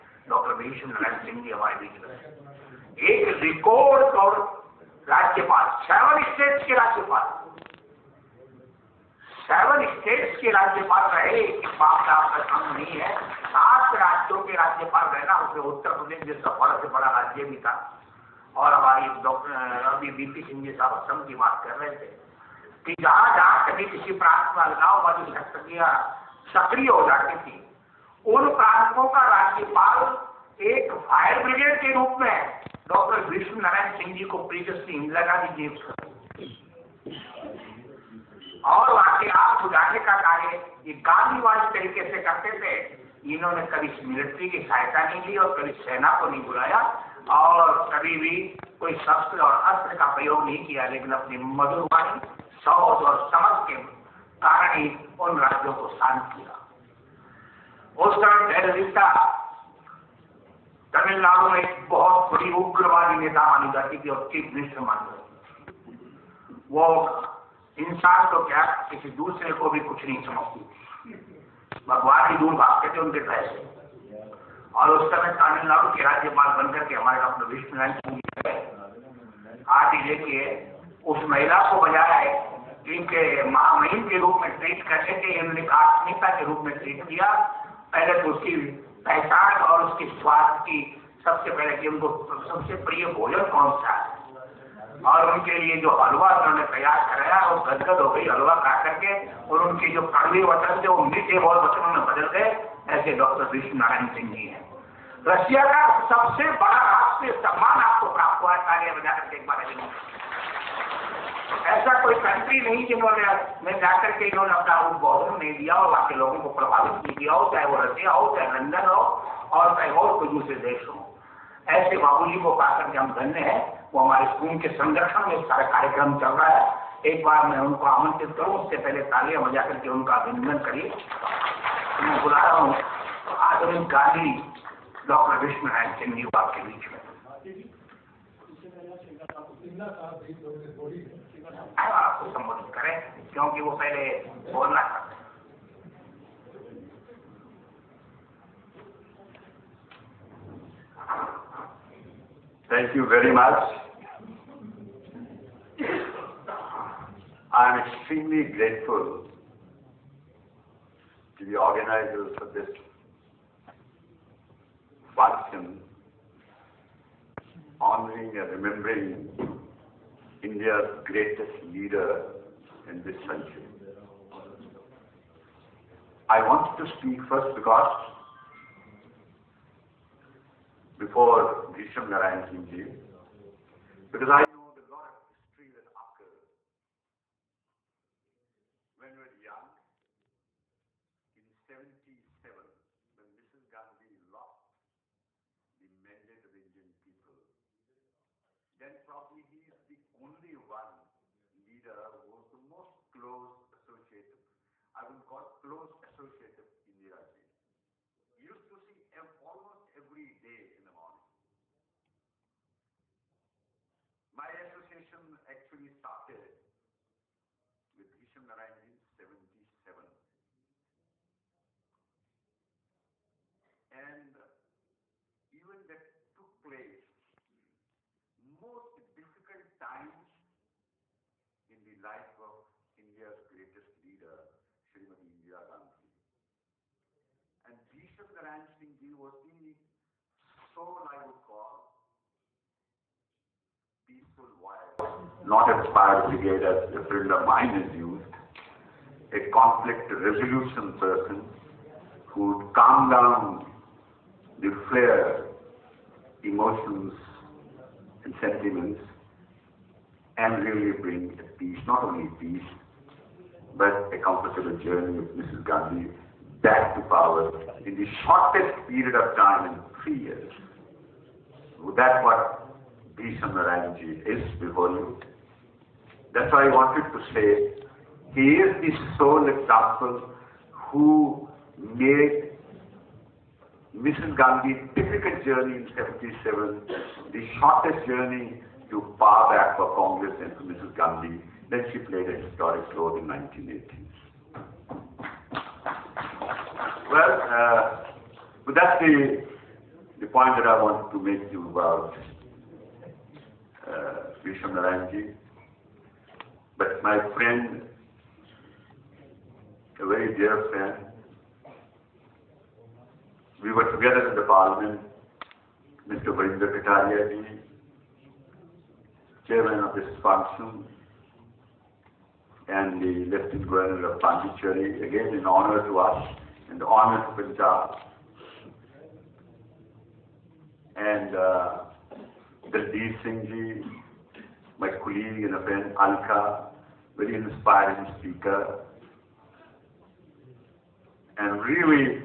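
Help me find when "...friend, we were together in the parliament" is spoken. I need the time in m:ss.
5:10.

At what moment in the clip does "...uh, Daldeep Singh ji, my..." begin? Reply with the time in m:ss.
5:31.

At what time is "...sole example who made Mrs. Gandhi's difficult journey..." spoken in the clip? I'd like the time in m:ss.
4:39.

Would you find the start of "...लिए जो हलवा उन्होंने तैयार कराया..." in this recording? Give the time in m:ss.
1:35.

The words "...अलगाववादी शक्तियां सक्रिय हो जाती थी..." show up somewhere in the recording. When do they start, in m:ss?
0:24.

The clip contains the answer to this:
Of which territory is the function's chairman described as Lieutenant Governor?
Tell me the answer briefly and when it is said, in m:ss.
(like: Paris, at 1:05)
Pondicherry, at 5:24.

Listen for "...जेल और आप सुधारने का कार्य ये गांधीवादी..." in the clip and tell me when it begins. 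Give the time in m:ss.
0:35.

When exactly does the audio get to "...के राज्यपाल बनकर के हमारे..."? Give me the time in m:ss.
1:15.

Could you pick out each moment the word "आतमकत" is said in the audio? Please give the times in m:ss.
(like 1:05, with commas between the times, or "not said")
1:25.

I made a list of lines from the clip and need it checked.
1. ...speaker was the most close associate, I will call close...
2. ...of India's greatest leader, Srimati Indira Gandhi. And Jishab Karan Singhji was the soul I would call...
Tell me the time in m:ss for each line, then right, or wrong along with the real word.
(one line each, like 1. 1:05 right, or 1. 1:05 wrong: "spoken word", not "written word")
1. 3:21 wrong: "leader", not "speaker"
2. 3:52 right.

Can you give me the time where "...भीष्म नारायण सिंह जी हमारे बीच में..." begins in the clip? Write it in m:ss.
0:00.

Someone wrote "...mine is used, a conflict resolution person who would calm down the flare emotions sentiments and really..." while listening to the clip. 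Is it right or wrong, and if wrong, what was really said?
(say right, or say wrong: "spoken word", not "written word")
right.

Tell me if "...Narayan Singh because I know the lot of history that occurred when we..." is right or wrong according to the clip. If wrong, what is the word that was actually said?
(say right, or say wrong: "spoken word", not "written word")
right.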